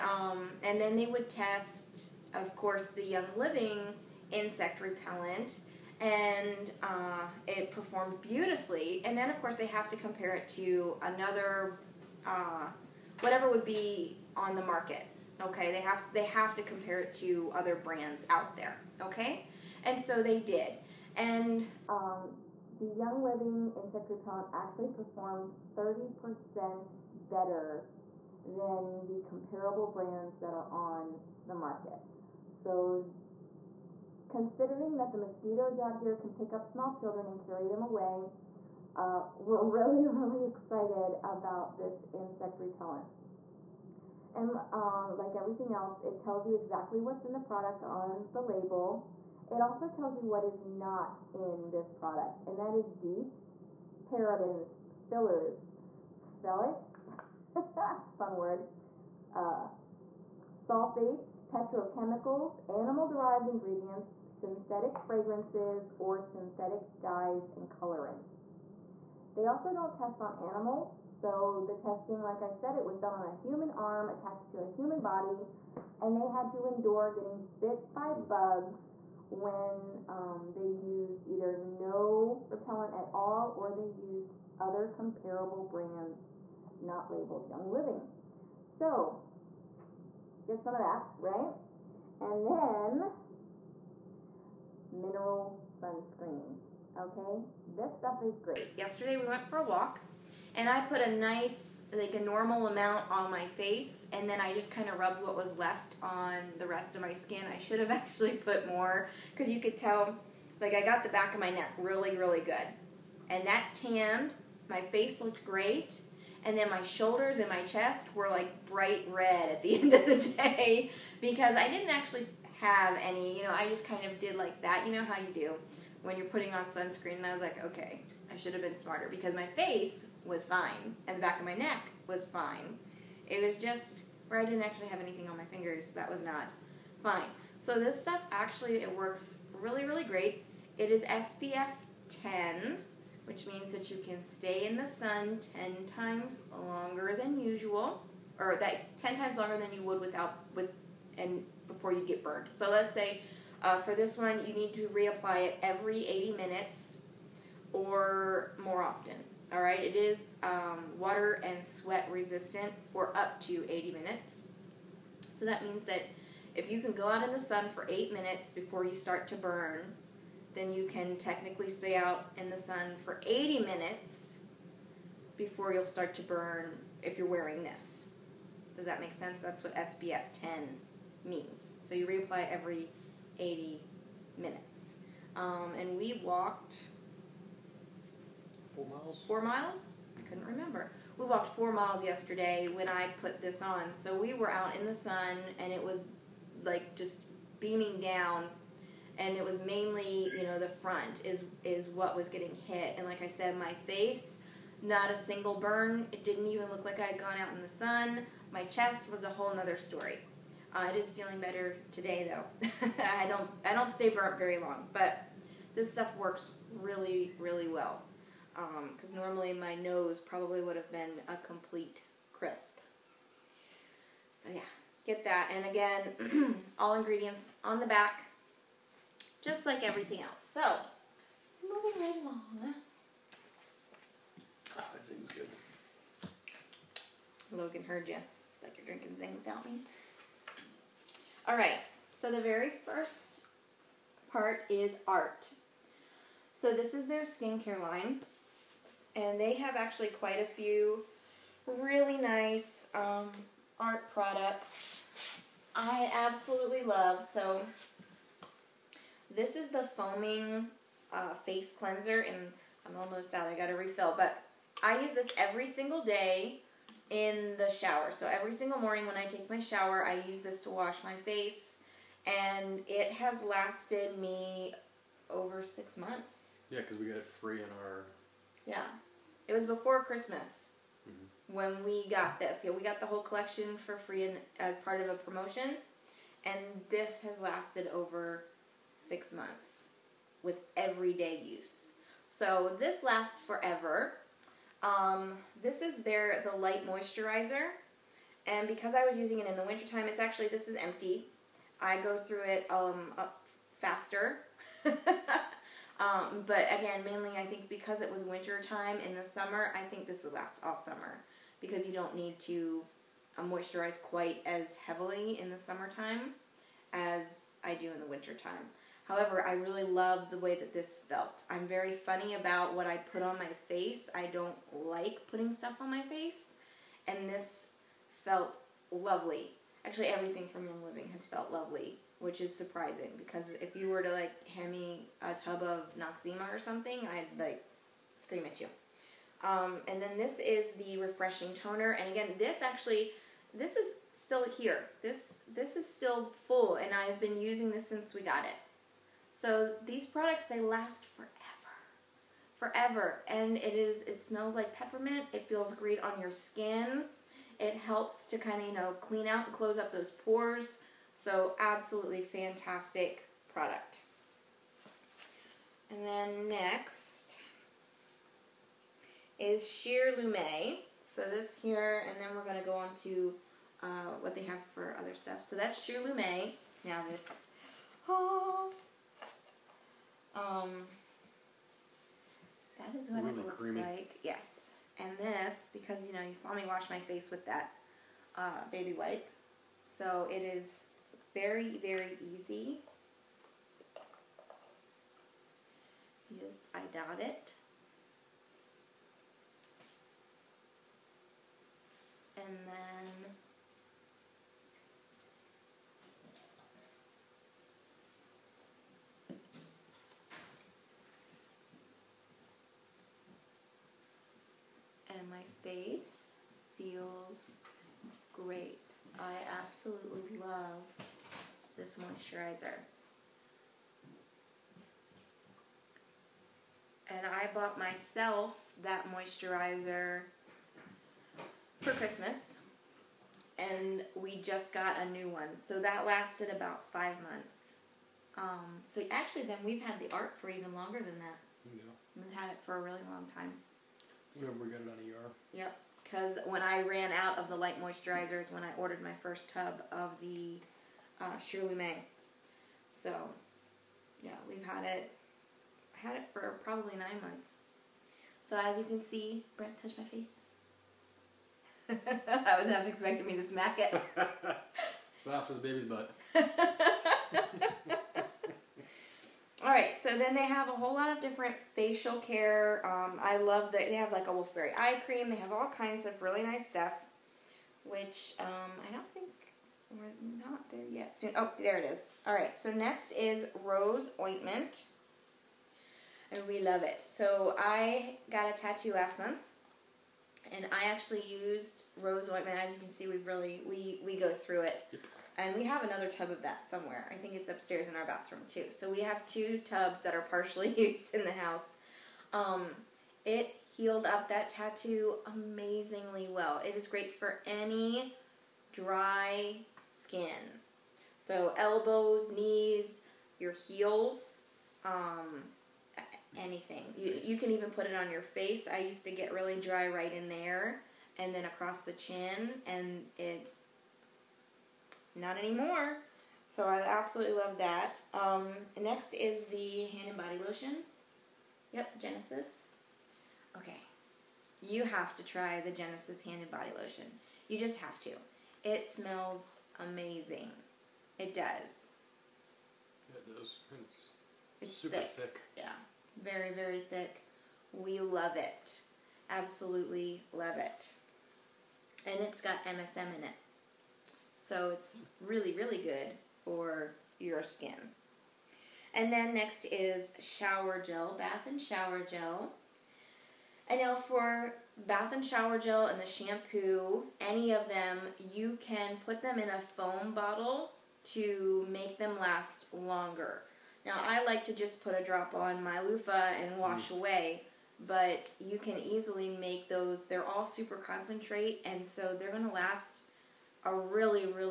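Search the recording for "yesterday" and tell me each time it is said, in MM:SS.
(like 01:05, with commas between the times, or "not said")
01:38, 03:12.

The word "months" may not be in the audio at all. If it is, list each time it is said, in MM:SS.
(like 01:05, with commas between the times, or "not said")
04:35, 04:49, 07:17, 07:37, 08:09.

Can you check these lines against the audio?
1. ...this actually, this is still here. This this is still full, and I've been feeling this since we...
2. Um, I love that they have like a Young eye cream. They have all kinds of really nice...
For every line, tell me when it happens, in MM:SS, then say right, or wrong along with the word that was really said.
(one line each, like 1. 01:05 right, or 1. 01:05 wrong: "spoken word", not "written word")
1. 05:42 wrong: "using", not "feeling"
2. 07:52 wrong: "Wolfberry", not "Young".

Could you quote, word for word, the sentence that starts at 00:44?
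And uh, like everything else, it tells you exactly what's in the product on the label.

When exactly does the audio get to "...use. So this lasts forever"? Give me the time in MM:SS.
04:51.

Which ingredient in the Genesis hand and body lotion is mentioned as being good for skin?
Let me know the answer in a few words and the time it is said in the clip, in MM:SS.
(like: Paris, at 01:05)
MSM, at 09:12.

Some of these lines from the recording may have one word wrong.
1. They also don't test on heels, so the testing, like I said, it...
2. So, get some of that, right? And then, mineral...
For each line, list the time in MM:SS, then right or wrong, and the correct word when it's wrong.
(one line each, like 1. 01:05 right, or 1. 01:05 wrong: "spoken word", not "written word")
1. 01:09 wrong: "animals", not "heels"
2. 01:28 right.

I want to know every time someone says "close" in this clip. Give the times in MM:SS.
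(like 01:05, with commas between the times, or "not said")
05:59.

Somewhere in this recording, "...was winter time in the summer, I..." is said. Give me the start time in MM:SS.
05:08.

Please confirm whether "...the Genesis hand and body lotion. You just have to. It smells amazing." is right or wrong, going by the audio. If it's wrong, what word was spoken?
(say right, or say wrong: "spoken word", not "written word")
right.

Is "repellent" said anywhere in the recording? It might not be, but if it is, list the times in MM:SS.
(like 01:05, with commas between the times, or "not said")
00:04, 00:24, 00:42, 01:22.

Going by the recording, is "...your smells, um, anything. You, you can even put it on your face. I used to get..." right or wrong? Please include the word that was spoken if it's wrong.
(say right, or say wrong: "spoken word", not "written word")
wrong: "heels", not "smells".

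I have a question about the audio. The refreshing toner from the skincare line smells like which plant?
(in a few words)
Peppermint.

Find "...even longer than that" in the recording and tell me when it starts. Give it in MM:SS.
07:20.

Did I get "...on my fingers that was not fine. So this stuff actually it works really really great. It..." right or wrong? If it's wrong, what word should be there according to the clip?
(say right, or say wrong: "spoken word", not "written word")
right.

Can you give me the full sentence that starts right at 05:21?
I'm very funny about what I put on my face.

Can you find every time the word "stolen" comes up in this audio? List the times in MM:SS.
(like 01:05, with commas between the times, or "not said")
not said.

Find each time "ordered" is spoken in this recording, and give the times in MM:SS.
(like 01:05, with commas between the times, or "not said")
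07:28.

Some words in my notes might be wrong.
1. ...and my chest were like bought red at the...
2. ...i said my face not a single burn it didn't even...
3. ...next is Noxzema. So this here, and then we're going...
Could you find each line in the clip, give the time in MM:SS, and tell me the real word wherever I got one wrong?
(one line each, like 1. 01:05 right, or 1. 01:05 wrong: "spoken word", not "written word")
1. 01:57 wrong: "bright", not "bought"
2. 03:23 right
3. 06:06 wrong: "Sheerlumé", not "Noxzema".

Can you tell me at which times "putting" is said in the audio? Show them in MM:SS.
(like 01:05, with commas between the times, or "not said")
02:06, 05:25.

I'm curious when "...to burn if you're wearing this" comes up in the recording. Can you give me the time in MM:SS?
02:56.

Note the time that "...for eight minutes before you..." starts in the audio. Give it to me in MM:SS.
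02:47.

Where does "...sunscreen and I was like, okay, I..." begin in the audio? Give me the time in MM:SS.
02:06.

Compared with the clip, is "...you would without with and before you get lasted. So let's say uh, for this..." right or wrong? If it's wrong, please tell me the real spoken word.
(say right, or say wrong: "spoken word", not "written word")
wrong: "burned", not "lasted".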